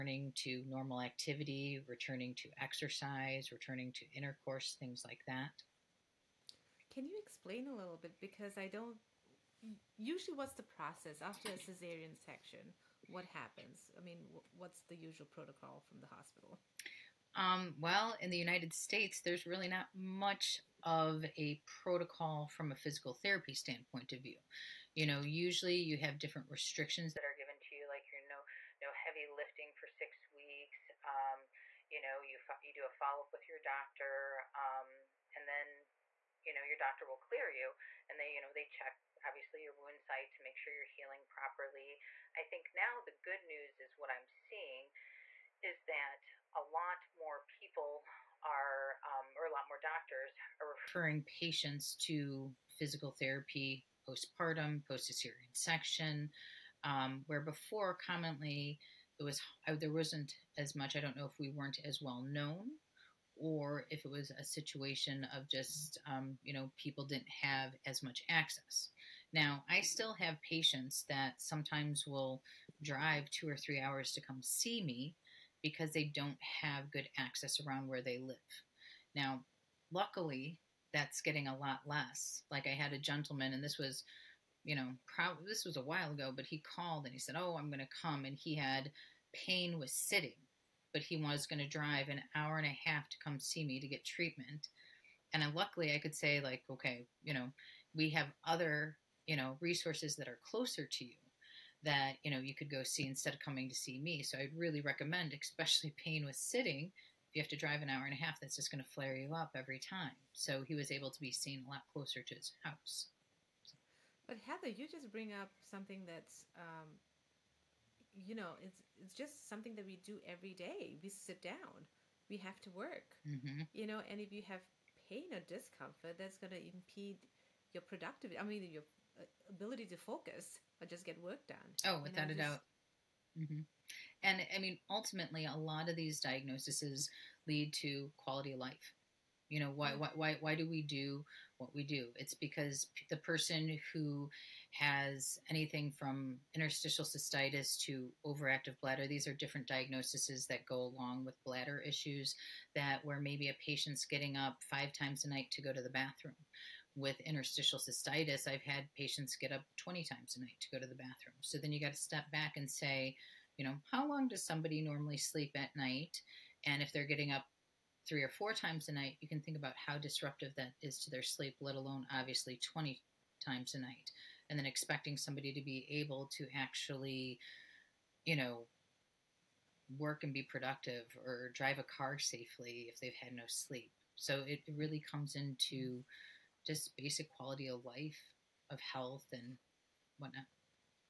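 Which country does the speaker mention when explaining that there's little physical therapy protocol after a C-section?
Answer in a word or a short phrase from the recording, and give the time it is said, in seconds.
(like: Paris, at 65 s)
United States, at 18 s.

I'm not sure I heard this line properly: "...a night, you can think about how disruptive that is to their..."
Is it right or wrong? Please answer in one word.
right.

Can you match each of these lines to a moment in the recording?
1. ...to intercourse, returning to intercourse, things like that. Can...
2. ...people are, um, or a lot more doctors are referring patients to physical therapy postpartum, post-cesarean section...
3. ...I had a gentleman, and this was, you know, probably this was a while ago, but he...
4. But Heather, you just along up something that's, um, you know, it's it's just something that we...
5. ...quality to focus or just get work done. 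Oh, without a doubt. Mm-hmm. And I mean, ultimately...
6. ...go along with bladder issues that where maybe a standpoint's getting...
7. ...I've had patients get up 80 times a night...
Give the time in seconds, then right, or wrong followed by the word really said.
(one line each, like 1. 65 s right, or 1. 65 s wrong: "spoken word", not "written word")
1. 2 s wrong: "exercise", not "intercourse"
2. 47 s right
3. 82 s right
4. 114 s wrong: "bring", not "along"
5. 129 s wrong: "ability", not "quality"
6. 150 s wrong: "patient", not "standpoint"
7. 158 s wrong: "20", not "80".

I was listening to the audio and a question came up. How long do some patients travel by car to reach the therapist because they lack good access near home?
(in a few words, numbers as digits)
2 or 3 hours.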